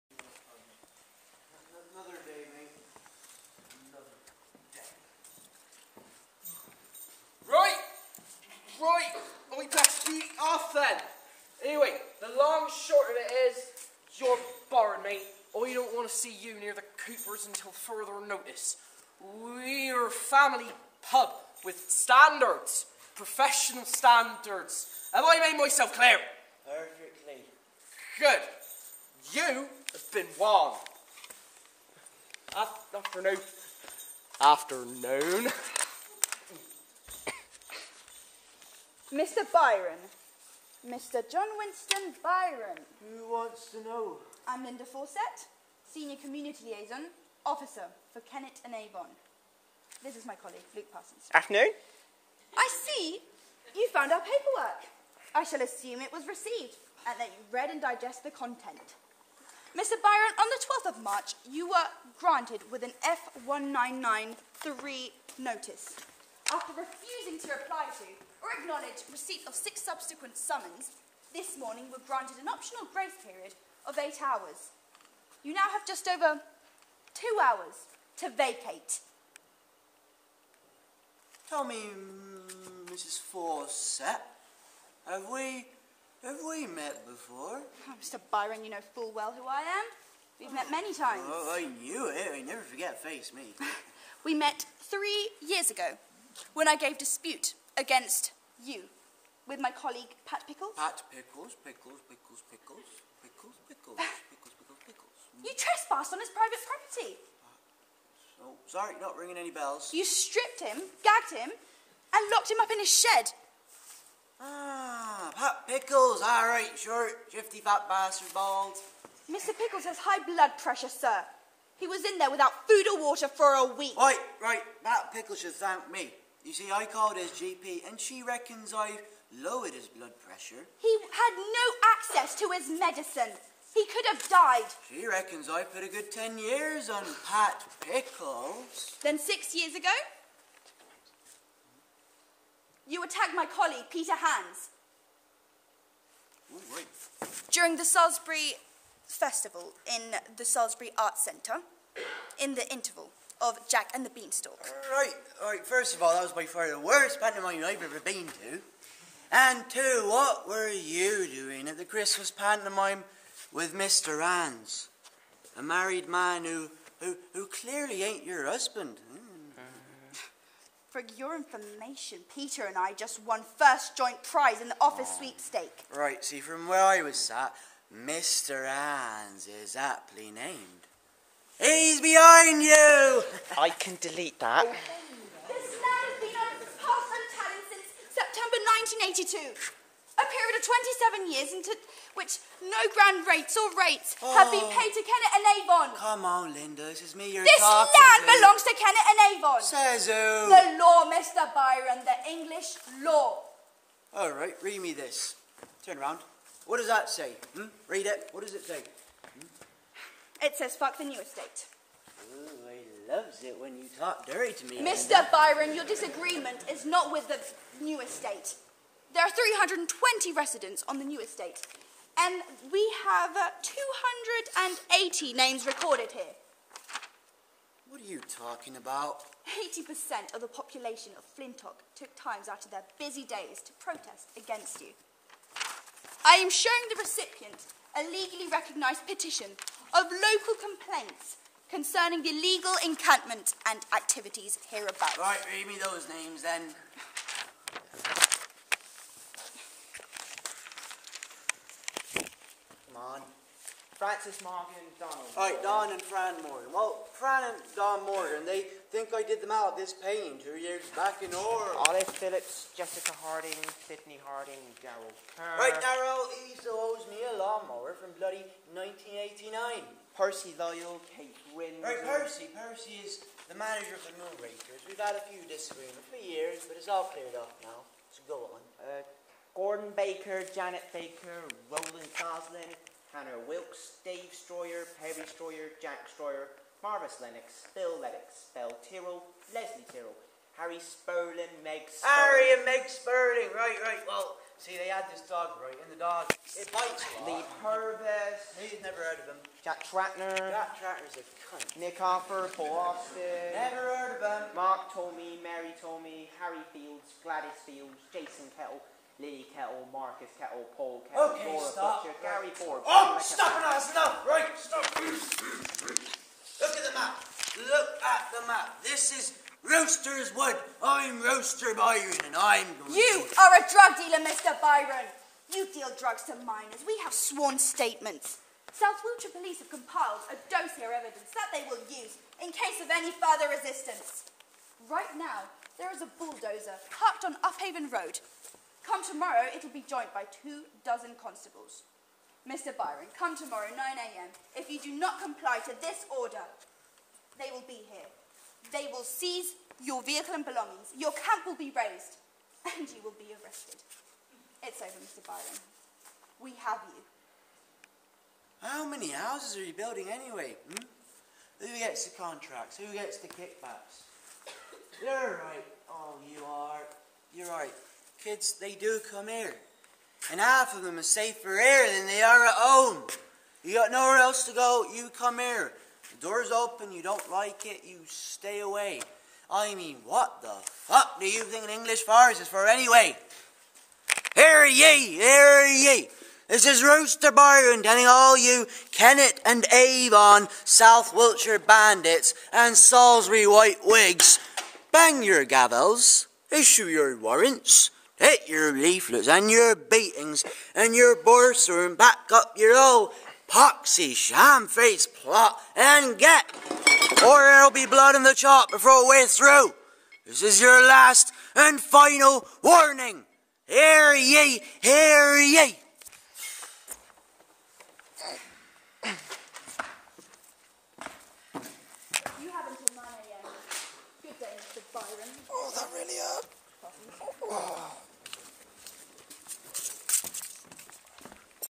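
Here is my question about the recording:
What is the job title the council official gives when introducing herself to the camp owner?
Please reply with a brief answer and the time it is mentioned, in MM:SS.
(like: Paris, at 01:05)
Senior Community Liaison Officer, at 00:45.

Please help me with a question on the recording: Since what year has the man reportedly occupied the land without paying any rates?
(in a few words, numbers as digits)
1982.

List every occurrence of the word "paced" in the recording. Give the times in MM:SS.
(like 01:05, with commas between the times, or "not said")
not said.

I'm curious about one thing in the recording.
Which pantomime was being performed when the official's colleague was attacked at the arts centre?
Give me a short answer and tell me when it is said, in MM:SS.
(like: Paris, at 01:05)
Jack and the Beanstalk, at 02:33.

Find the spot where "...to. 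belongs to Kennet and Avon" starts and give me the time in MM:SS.
03:18.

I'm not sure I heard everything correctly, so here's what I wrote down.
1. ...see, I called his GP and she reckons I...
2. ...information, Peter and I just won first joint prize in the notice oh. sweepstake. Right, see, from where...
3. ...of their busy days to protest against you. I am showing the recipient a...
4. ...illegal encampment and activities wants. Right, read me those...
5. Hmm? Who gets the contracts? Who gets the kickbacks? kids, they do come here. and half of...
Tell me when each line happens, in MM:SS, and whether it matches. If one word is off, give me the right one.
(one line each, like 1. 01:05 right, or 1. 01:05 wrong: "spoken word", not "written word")
1. 02:06 right
2. 02:51 wrong: "office", not "notice"
3. 03:52 right
4. 04:02 wrong: "hereabouts", not "wants"
5. 06:00 right.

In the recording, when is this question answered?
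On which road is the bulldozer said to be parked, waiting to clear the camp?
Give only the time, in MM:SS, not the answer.
05:37.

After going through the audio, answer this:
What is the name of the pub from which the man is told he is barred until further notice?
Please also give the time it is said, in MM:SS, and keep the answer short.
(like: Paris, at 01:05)
the Coopers, at 00:16.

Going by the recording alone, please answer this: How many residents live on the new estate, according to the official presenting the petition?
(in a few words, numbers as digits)
320.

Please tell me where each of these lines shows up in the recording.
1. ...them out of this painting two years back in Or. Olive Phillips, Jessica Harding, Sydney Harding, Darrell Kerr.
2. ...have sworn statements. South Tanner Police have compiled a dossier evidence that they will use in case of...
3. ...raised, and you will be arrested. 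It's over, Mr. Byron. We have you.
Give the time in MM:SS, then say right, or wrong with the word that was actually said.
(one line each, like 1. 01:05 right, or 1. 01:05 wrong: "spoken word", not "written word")
1. 04:19 right
2. 05:27 wrong: "Wiltshire", not "Tanner"
3. 05:51 right.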